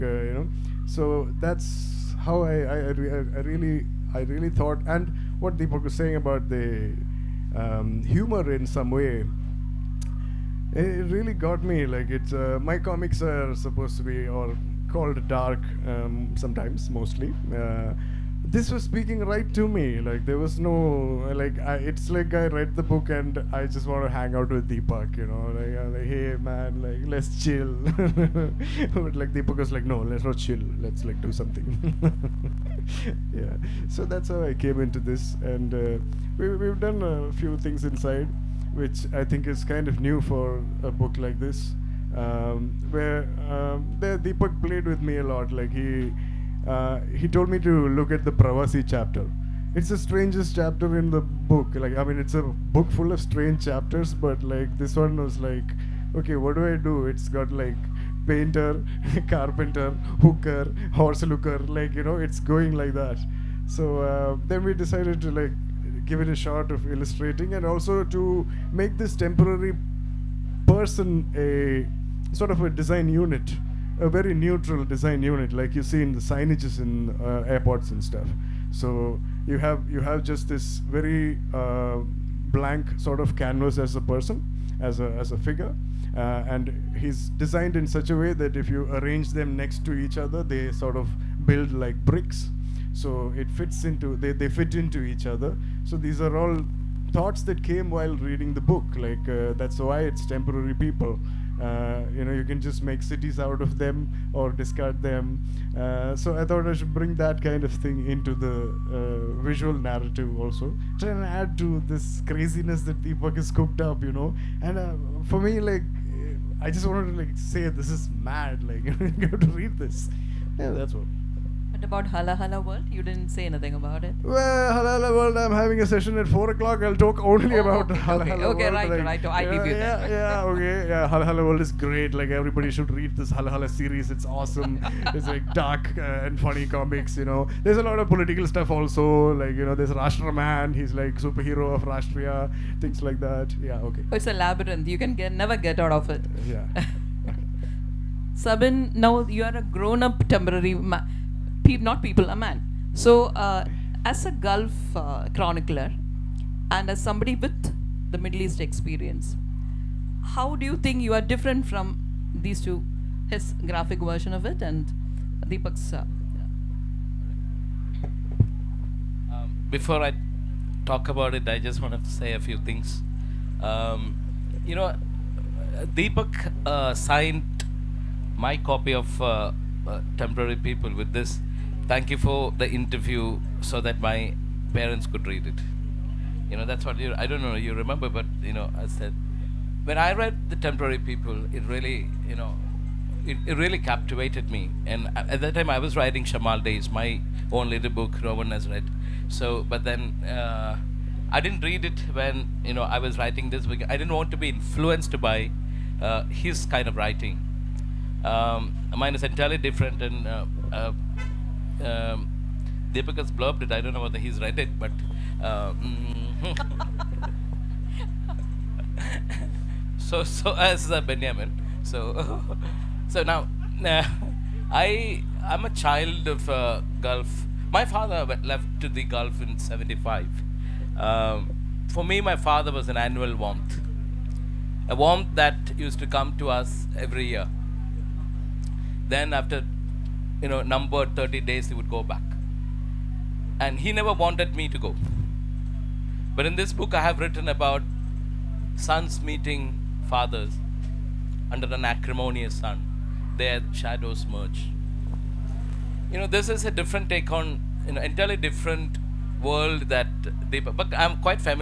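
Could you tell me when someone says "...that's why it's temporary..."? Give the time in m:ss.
1:39.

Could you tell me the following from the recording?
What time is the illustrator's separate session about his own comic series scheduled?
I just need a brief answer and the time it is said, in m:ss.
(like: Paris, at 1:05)
4 o'clock, at 2:06.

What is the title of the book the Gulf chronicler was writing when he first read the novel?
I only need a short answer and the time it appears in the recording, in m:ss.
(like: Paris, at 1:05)
Shamal Days, at 3:16.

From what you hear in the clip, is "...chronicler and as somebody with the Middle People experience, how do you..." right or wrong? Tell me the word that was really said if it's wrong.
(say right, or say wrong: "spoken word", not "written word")
wrong: "East", not "People".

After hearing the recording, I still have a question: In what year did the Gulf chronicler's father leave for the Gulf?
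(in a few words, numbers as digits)
1975.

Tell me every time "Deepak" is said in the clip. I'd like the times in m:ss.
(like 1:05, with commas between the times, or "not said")
0:05, 0:24, 0:29, 0:44, 1:53, 2:45, 2:55, 4:20.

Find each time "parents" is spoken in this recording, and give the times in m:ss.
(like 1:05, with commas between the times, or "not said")
3:04.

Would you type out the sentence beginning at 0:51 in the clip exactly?
Like I mean, it's a book full of strange chapters, but like this one was like, okay, what do I do?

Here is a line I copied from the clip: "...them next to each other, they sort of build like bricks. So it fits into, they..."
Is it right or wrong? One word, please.
right.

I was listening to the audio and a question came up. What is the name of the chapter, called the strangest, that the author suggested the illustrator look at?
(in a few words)
Pravasi.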